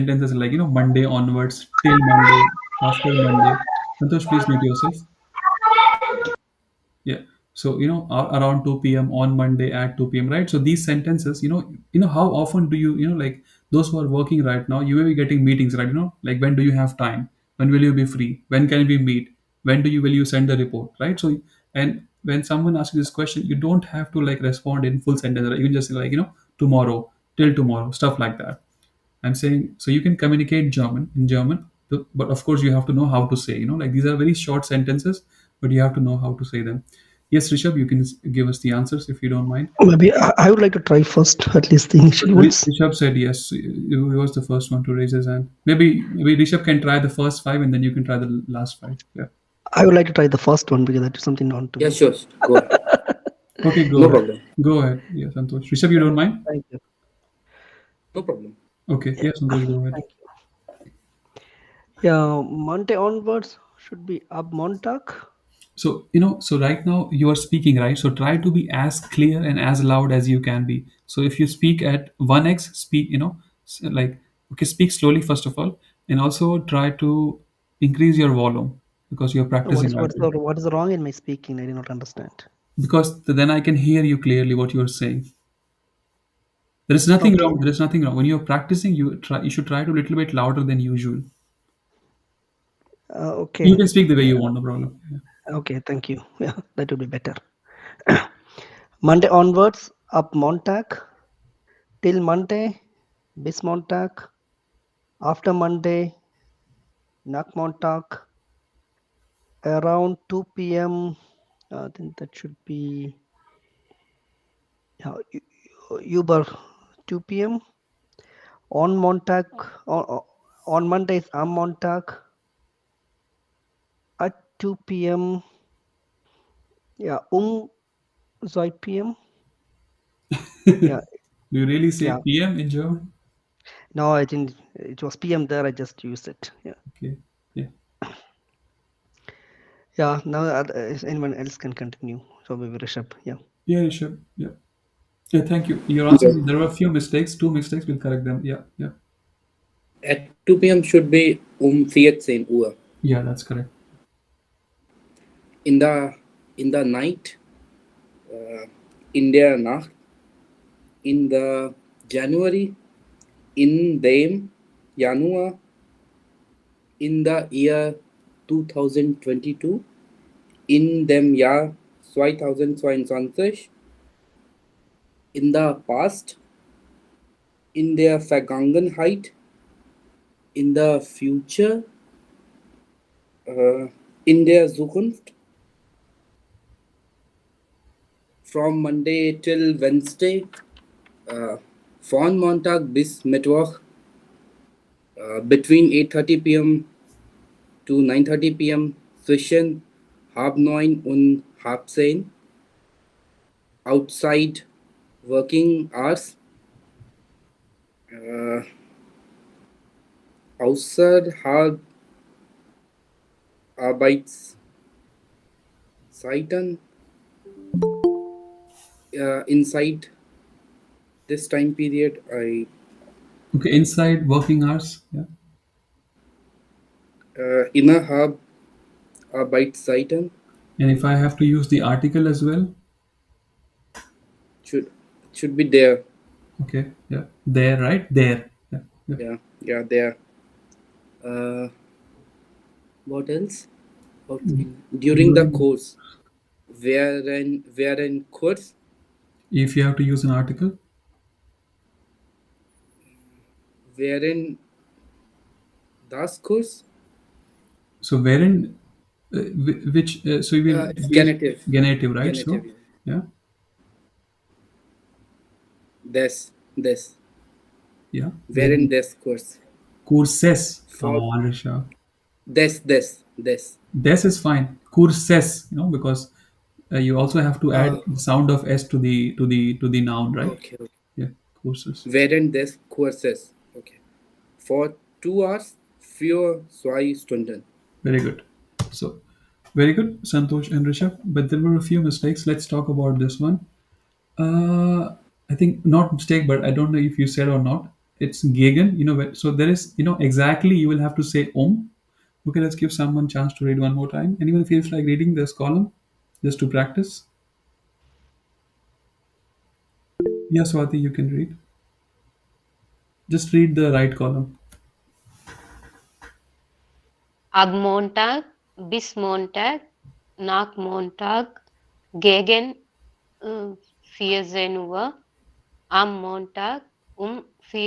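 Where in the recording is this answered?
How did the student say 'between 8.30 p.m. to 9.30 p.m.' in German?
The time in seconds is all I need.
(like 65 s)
199 s.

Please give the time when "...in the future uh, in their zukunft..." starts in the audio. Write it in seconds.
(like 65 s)
180 s.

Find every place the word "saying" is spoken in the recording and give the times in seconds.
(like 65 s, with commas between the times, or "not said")
29 s, 84 s.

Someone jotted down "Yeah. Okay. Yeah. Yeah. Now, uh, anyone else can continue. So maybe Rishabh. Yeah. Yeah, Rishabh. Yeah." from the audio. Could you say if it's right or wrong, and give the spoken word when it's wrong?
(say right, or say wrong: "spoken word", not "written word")
right.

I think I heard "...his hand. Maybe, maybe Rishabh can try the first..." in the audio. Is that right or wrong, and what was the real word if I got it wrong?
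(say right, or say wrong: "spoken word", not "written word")
right.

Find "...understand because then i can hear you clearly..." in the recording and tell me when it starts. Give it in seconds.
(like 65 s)
81 s.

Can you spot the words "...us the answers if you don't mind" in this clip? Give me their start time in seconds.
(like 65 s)
38 s.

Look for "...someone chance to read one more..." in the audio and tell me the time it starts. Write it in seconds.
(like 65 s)
302 s.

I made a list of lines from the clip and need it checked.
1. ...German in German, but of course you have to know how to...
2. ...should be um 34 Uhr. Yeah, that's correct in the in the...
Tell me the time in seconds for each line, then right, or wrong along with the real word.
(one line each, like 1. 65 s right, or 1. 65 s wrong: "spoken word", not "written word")
1. 30 s right
2. 150 s wrong: "14", not "34".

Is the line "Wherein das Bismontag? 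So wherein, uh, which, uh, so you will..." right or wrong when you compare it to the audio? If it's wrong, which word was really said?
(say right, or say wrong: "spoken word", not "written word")
wrong: "Kurs", not "Bismontag".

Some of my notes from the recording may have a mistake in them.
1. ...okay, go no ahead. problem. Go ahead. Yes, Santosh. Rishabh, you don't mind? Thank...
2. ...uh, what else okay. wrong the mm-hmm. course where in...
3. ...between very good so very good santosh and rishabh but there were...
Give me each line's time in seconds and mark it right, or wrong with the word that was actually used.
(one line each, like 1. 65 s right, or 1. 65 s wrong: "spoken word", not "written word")
1. 53 s right
2. 241 s wrong: "during", not "wrong"
3. 287 s wrong: "stunden", not "between".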